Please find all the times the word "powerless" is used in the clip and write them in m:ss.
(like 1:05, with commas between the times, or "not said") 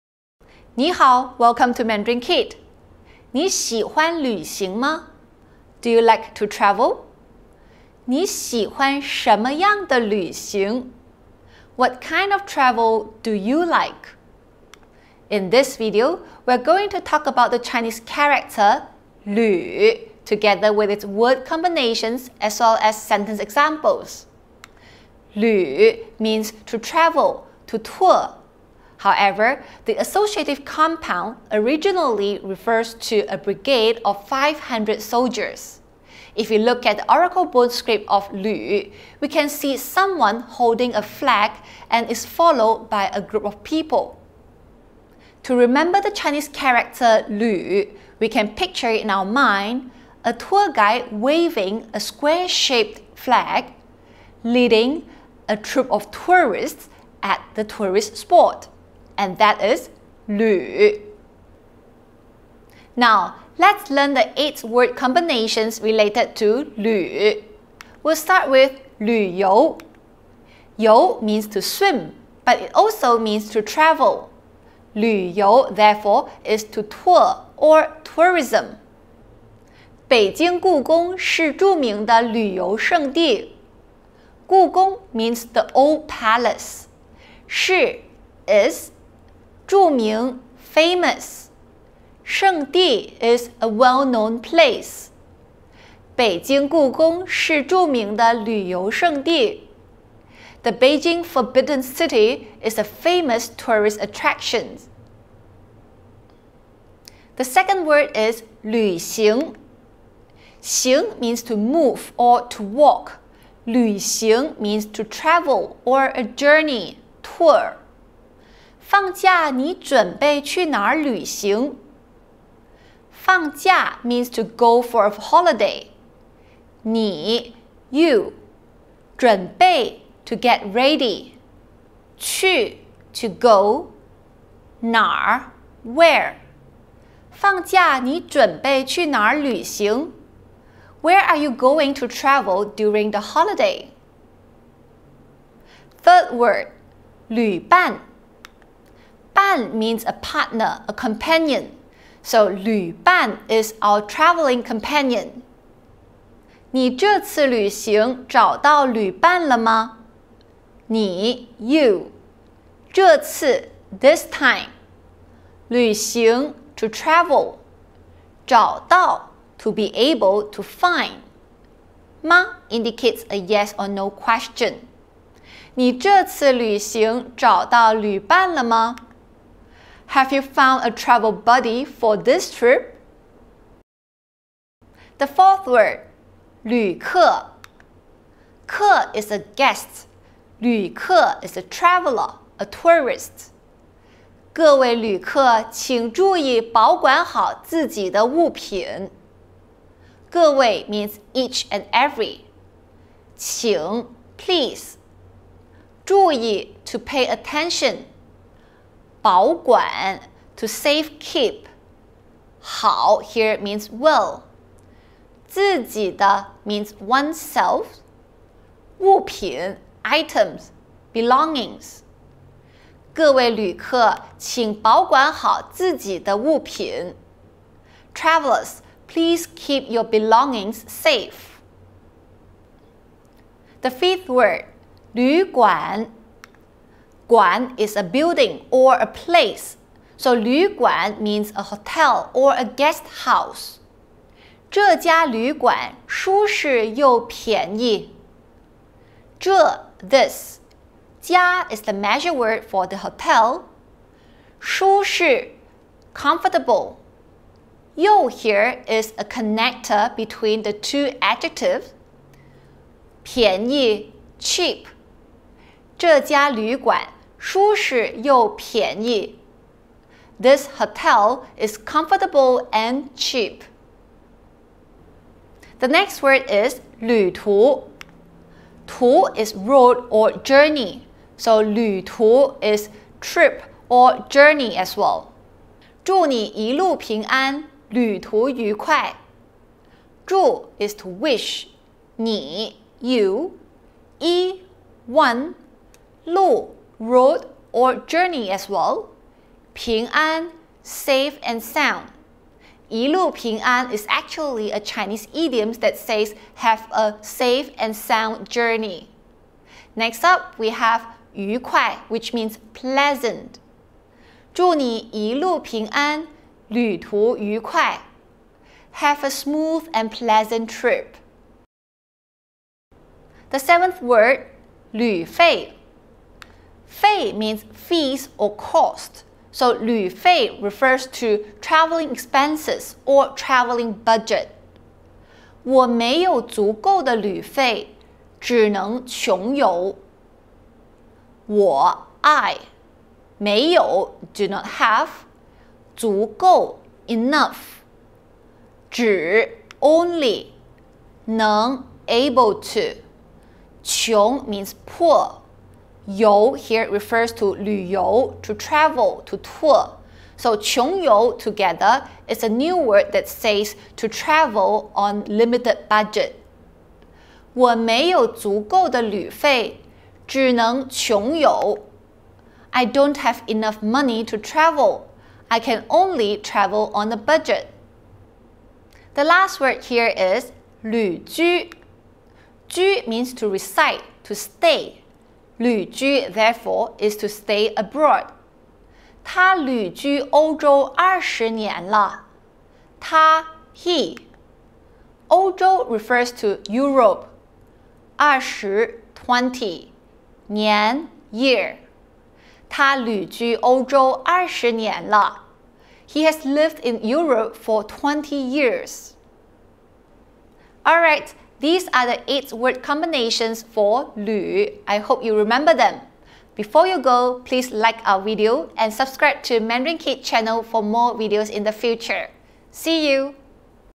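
not said.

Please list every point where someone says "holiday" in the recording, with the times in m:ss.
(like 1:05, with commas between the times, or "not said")
2:05, 2:23.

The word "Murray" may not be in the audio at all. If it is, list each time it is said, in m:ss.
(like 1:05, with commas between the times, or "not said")
not said.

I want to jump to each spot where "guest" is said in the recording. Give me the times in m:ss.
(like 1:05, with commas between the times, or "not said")
3:09, 4:02.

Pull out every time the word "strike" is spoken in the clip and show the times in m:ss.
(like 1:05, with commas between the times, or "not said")
not said.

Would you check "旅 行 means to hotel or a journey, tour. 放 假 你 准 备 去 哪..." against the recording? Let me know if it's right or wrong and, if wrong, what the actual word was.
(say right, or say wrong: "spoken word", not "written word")
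wrong: "travel", not "hotel".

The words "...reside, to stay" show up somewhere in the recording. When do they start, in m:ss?
6:23.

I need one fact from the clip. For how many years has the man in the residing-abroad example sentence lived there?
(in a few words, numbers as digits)
20.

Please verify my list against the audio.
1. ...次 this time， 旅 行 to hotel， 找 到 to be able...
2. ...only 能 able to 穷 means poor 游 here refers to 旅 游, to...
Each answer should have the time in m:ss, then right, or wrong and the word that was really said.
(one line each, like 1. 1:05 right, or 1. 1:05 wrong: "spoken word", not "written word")
1. 2:43 wrong: "travel", not "hotel"
2. 5:49 right.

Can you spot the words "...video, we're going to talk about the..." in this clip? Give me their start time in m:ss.
0:15.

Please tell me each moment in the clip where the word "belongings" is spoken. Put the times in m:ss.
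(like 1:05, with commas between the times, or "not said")
3:41, 3:50.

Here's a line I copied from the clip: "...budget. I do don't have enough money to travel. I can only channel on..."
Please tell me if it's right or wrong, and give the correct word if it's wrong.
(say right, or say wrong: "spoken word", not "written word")
wrong: "travel", not "channel".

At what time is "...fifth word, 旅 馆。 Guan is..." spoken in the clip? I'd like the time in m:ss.
3:53.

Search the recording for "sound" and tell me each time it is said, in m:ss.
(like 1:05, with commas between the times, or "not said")
5:01, 5:07.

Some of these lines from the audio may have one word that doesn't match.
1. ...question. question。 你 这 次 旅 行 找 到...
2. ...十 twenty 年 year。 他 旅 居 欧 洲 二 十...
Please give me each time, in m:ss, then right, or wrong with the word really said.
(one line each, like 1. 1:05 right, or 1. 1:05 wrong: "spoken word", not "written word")
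1. 2:54 right
2. 6:38 right.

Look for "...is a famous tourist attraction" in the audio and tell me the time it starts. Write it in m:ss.
1:42.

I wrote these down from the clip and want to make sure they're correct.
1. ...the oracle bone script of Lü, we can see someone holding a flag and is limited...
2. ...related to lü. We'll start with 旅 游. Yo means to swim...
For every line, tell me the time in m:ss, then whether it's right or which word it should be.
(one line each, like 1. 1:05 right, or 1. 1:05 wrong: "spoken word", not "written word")
1. 0:36 wrong: "followed", not "limited"
2. 1:05 right.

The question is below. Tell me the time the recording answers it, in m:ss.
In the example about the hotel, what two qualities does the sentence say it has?
4:31.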